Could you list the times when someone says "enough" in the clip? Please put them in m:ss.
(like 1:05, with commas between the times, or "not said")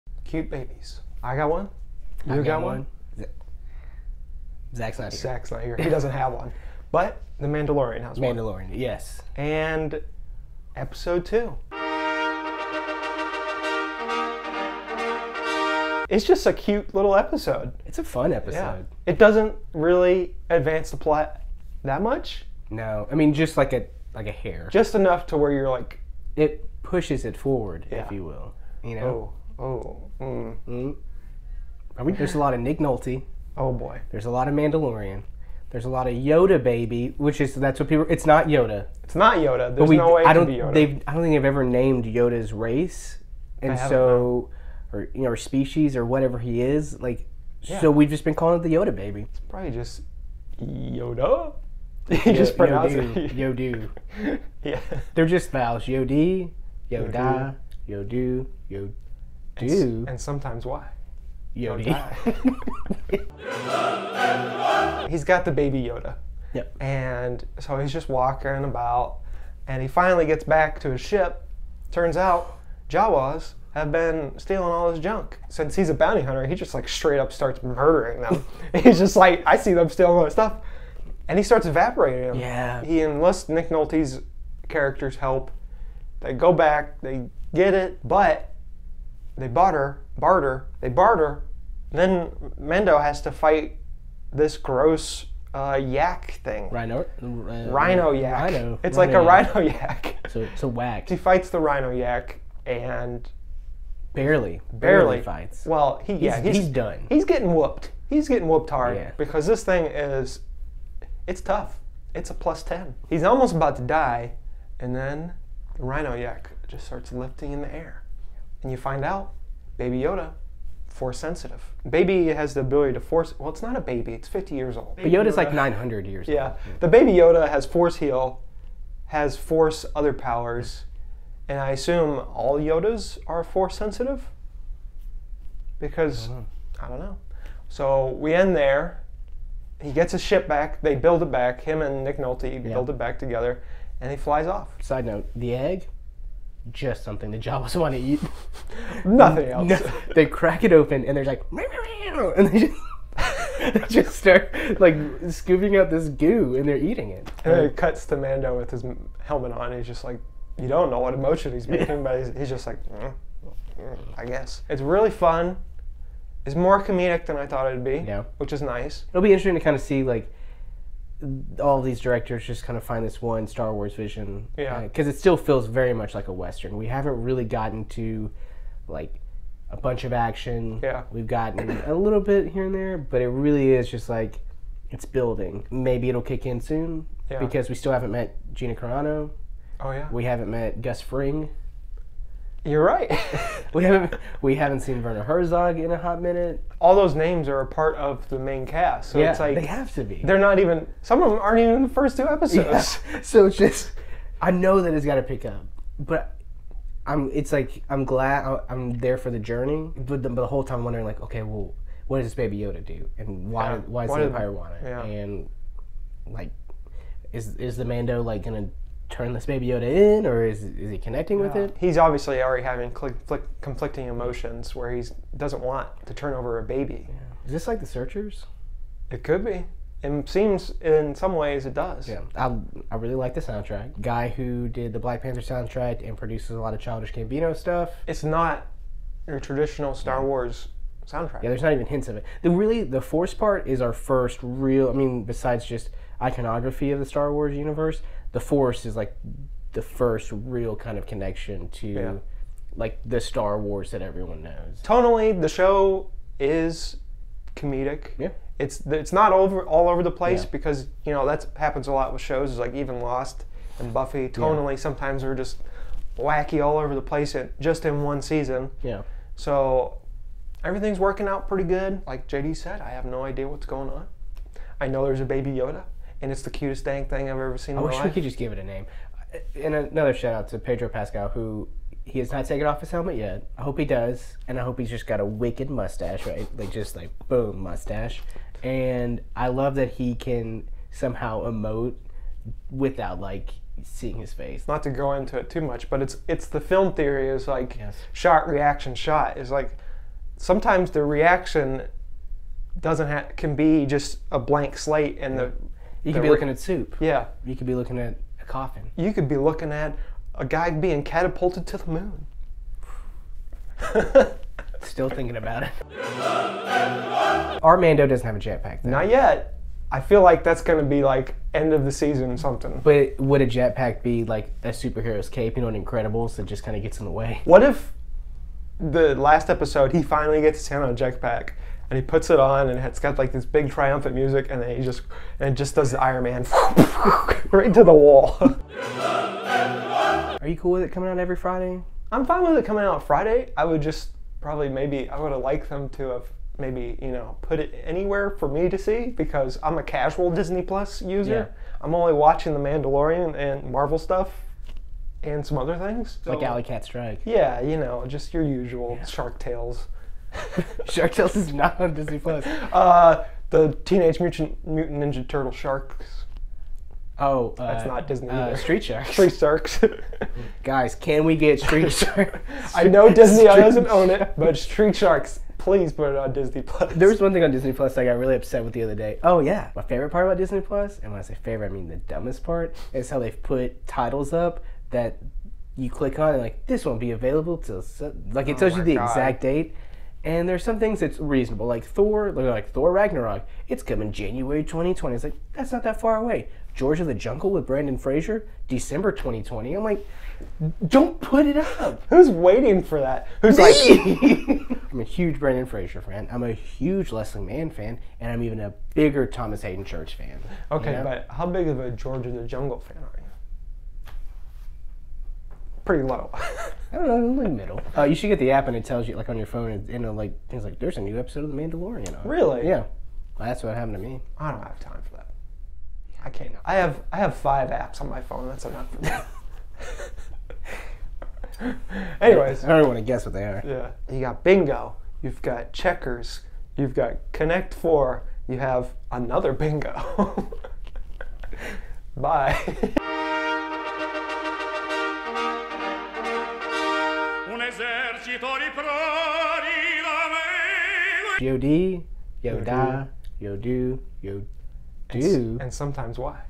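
0:24, 7:08.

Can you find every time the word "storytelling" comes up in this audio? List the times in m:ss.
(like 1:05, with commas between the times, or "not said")
not said.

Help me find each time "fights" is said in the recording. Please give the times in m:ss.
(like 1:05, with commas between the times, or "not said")
1:33, 1:41, 1:45.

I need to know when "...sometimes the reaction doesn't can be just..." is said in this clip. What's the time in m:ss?
5:00.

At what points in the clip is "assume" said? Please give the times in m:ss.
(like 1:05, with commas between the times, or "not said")
2:11.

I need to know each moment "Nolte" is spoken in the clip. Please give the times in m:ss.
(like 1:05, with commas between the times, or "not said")
0:32, 1:23, 2:22.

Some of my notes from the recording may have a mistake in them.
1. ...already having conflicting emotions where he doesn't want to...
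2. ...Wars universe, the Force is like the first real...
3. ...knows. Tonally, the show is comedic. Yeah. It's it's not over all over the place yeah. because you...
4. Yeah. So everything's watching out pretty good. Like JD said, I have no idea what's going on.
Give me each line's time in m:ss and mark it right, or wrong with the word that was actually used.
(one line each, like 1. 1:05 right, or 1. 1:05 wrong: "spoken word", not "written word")
1. 3:42 right
2. 4:07 right
3. 4:14 right
4. 4:28 wrong: "working", not "watching".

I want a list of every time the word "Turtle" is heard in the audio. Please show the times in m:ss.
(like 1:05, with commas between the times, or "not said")
6:05.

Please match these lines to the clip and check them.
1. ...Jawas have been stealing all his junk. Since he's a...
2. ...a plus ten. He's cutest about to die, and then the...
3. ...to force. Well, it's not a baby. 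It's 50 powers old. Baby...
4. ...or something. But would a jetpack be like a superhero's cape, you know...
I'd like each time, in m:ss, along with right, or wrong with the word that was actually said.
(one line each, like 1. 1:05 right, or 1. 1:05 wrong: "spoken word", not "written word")
1. 1:12 right
2. 1:52 wrong: "almost", not "cutest"
3. 2:02 wrong: "years", not "powers"
4. 5:22 right.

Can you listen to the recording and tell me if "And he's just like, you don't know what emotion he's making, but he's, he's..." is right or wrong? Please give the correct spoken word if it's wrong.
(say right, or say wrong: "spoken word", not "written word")
right.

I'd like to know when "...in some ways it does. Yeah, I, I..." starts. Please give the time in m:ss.
3:50.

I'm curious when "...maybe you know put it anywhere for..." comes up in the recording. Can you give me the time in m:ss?
5:46.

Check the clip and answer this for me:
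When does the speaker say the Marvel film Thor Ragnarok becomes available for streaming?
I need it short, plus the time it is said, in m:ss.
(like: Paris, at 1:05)
January 2020, at 6:34.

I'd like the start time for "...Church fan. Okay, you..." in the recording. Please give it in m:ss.
6:49.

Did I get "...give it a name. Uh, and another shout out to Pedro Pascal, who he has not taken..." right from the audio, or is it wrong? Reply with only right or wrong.
right.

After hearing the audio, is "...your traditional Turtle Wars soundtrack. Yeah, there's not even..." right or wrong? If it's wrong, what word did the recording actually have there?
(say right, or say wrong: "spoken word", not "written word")
wrong: "Star", not "Turtle".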